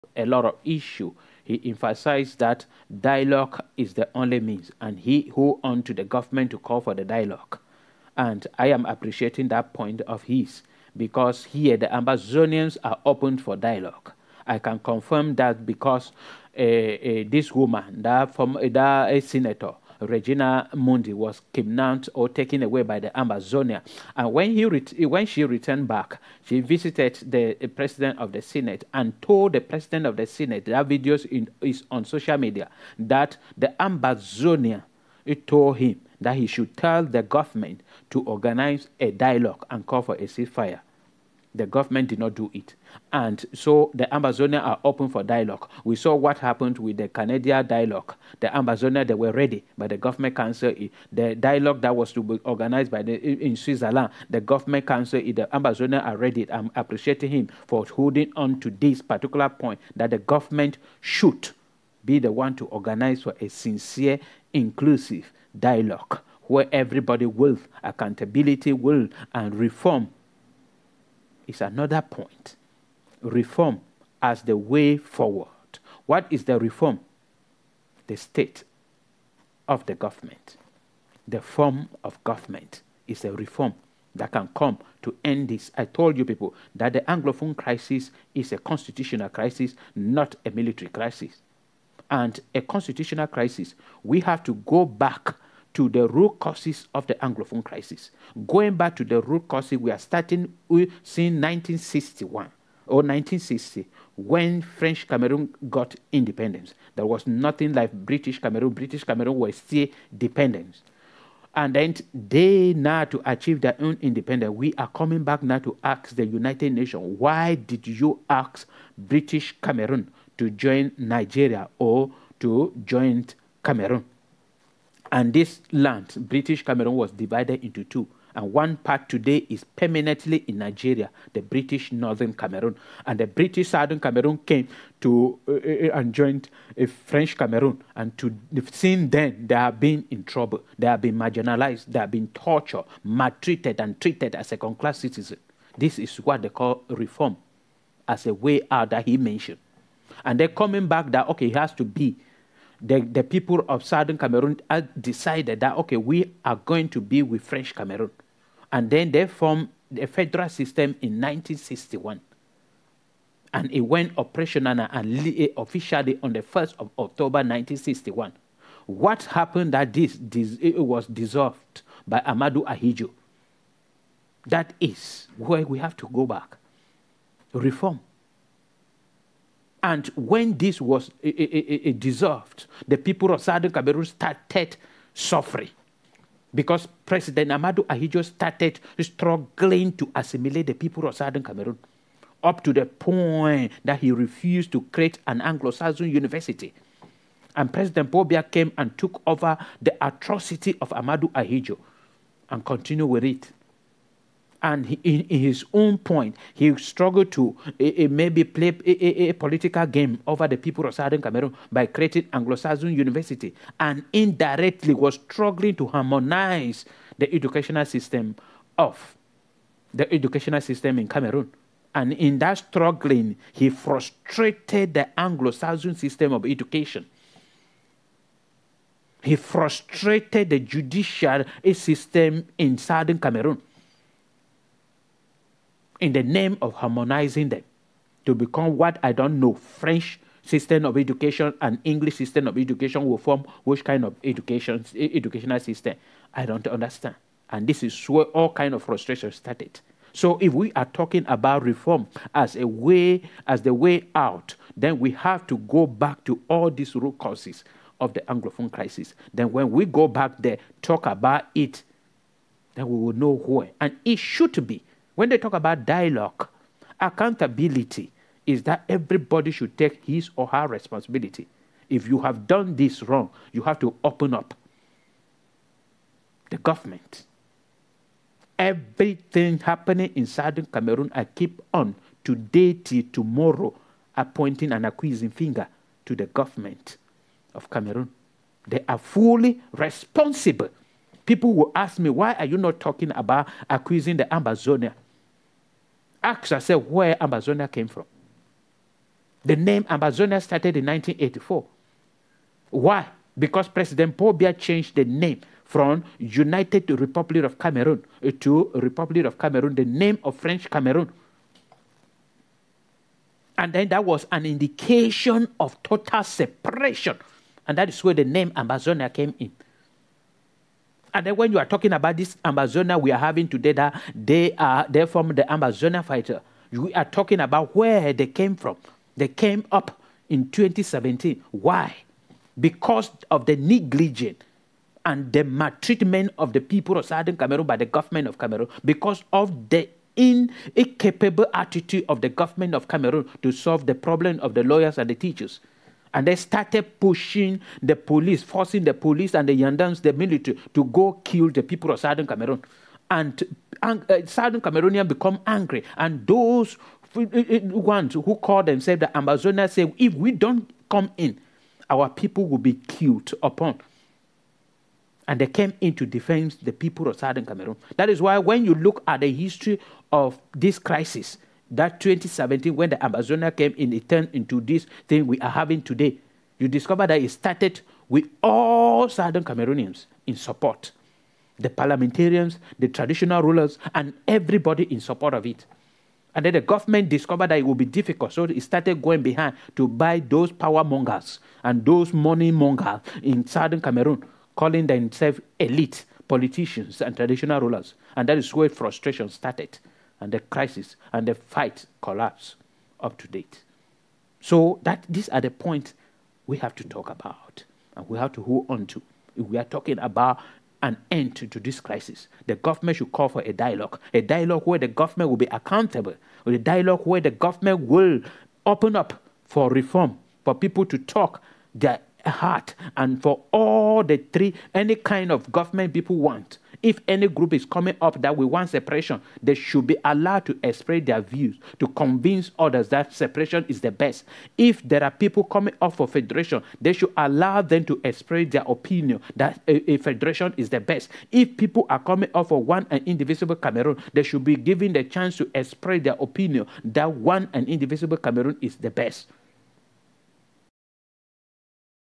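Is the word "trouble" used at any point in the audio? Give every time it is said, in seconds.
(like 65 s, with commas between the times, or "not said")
140 s.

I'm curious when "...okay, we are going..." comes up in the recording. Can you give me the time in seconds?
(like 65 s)
155 s.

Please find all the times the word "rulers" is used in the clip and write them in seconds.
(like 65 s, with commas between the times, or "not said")
383 s, 397 s.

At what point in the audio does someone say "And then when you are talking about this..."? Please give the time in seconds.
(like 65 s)
321 s.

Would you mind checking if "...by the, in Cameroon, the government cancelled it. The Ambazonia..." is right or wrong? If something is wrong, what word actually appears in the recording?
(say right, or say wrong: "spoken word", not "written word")
wrong: "Switzerland", not "Cameroon".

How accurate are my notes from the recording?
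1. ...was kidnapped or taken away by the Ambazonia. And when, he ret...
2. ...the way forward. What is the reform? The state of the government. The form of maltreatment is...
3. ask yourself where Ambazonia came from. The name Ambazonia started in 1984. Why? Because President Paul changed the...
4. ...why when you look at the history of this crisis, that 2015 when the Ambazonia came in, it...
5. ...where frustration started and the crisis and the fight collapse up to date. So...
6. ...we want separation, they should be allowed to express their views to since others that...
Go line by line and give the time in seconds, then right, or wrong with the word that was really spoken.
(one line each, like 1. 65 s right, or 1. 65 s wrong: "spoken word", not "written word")
1. 21 s right
2. 74 s wrong: "government", not "maltreatment"
3. 296 s right
4. 368 s wrong: "2017", not "2015"
5. 398 s right
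6. 428 s wrong: "convince", not "since".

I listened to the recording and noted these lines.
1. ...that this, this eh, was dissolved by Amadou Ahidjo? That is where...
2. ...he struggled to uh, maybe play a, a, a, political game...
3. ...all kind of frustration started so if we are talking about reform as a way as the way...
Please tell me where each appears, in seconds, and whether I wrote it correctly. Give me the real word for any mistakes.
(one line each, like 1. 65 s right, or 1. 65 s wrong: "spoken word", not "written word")
1. 169 s right
2. 206 s right
3. 248 s right.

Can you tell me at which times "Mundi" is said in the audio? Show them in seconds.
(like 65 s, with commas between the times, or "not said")
20 s.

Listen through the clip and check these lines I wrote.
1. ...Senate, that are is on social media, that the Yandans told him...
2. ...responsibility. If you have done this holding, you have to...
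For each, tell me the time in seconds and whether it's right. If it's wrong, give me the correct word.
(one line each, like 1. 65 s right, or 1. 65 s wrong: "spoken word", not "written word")
1. 30 s wrong: "Ambazonia", not "Yandans"
2. 270 s wrong: "wrong", not "holding".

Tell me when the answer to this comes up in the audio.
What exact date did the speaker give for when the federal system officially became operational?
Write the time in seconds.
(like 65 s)
166 s.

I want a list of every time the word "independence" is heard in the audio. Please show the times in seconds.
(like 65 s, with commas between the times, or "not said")
106 s, 114 s.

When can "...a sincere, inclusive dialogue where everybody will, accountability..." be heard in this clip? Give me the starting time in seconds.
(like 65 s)
63 s.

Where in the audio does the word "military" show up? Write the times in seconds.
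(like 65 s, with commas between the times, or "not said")
90 s, 350 s.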